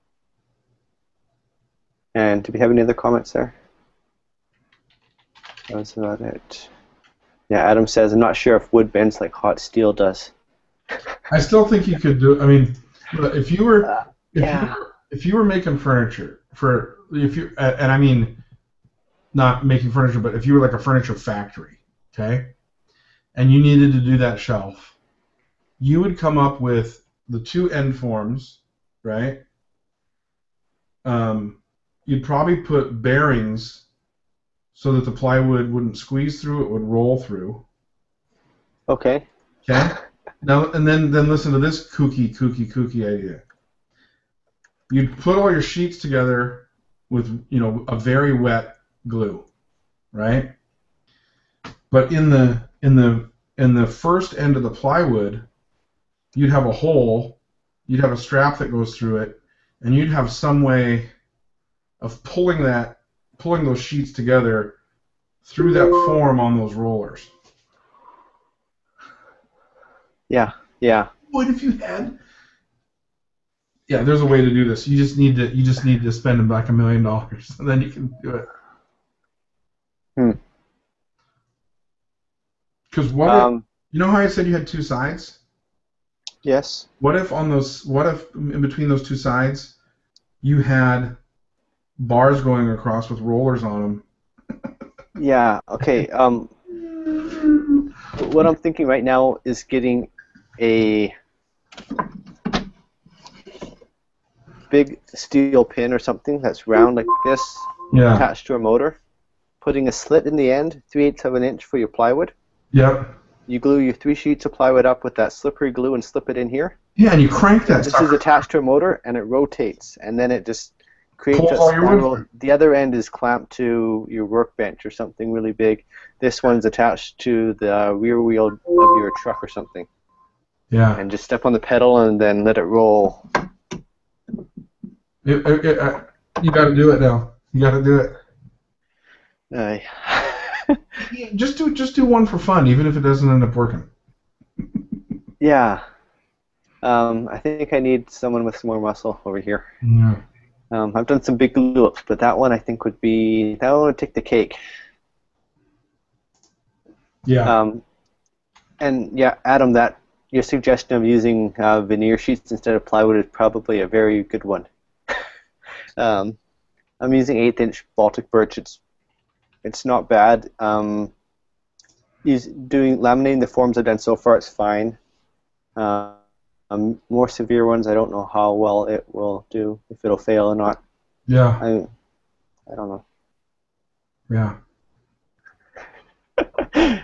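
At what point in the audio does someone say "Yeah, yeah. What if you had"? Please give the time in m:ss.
1:10.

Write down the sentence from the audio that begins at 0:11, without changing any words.
I still think you could do.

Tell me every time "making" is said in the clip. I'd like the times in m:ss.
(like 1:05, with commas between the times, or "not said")
0:15, 0:19.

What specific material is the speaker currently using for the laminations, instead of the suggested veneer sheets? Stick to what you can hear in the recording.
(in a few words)
eighth-inch Baltic birch.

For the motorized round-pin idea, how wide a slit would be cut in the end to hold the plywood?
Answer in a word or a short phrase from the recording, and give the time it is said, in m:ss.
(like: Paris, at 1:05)
3/8 inch, at 1:50.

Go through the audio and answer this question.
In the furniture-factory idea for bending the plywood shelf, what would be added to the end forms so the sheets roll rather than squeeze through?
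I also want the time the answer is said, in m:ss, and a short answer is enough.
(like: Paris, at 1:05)
bearings, at 0:33.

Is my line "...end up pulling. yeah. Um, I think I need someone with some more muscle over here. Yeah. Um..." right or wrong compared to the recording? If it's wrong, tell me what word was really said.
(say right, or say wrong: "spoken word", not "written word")
wrong: "working", not "pulling".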